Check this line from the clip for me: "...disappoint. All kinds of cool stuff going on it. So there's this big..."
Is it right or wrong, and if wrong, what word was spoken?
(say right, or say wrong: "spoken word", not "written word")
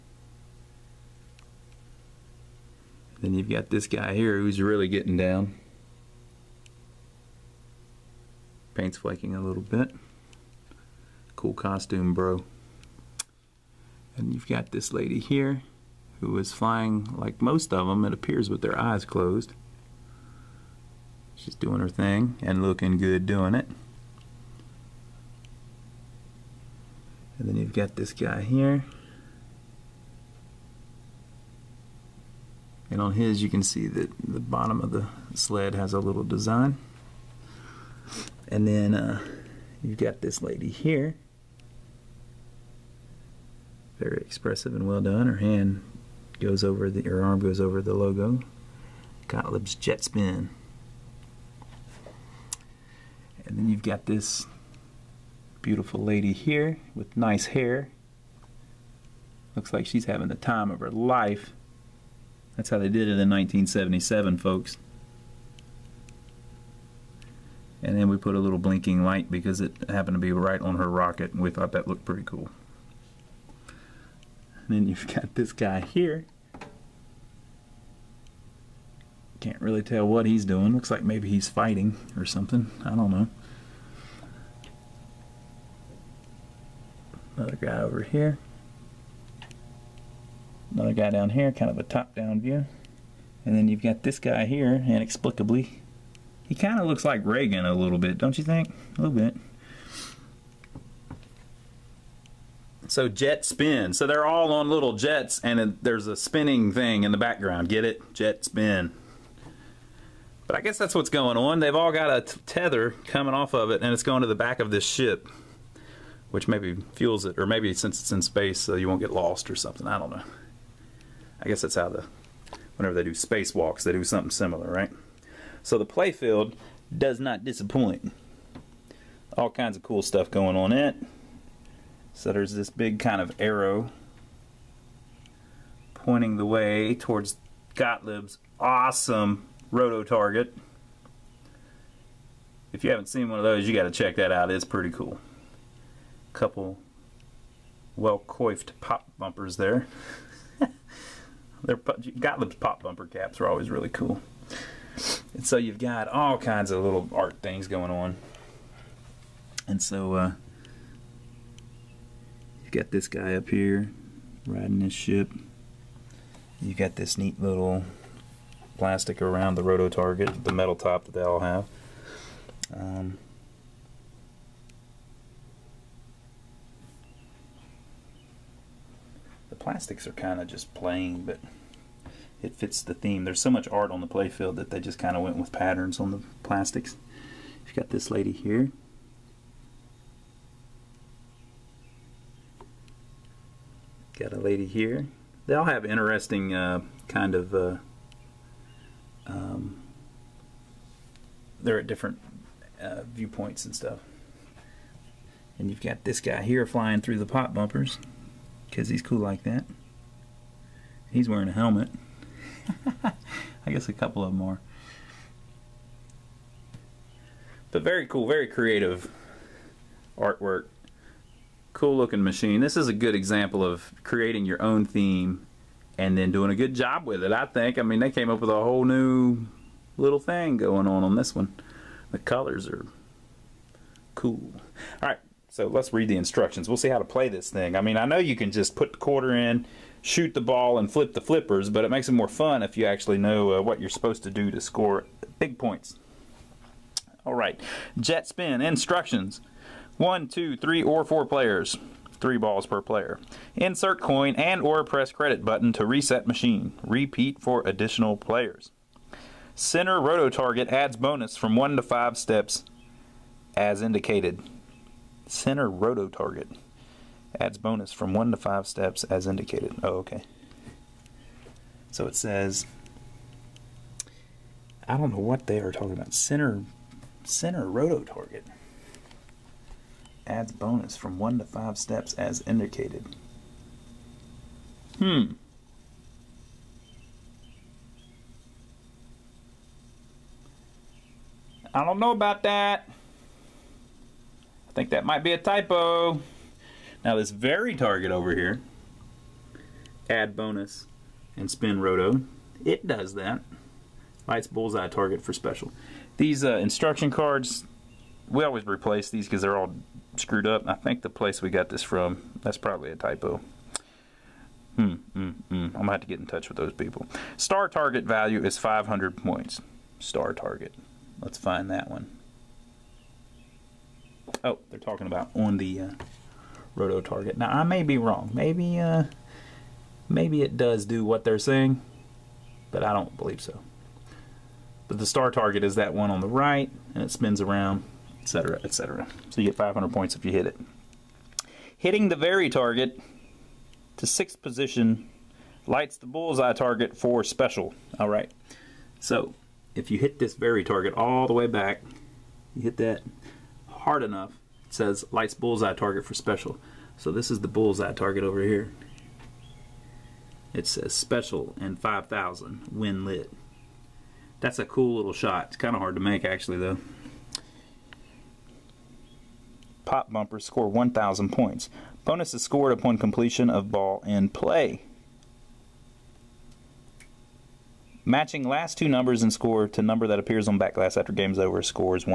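right.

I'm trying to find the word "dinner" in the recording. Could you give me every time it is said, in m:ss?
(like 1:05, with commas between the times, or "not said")
not said.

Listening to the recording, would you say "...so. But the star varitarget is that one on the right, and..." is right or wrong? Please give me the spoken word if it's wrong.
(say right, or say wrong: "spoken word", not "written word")
wrong: "target", not "varitarget".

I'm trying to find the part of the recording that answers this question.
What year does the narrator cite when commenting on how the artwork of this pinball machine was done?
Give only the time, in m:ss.
1:03.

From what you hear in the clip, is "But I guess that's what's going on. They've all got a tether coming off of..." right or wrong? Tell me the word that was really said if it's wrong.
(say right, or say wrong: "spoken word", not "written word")
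right.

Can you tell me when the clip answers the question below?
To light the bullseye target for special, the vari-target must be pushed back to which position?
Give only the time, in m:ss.
5:44.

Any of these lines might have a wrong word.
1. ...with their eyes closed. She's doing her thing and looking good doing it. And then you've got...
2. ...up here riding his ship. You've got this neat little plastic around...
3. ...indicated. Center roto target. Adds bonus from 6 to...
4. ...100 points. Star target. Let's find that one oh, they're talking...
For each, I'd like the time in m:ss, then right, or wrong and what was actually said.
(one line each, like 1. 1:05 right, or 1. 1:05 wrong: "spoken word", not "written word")
1. 0:18 right
2. 2:43 right
3. 4:23 wrong: "1", not "6"
4. 5:18 wrong: "500", not "100".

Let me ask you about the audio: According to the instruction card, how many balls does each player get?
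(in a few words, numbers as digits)
3.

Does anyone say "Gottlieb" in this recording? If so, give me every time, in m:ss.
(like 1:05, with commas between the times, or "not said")
0:49, 2:17, 2:32.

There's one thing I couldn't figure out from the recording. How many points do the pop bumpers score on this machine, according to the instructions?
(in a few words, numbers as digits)
1,000 points.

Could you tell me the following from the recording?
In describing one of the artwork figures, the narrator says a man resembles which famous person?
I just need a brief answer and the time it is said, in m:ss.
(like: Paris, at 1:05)
Reagan, at 1:37.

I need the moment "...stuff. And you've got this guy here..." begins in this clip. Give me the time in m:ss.
3:23.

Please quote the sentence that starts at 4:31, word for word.
So it says, I don't know what they are talking about.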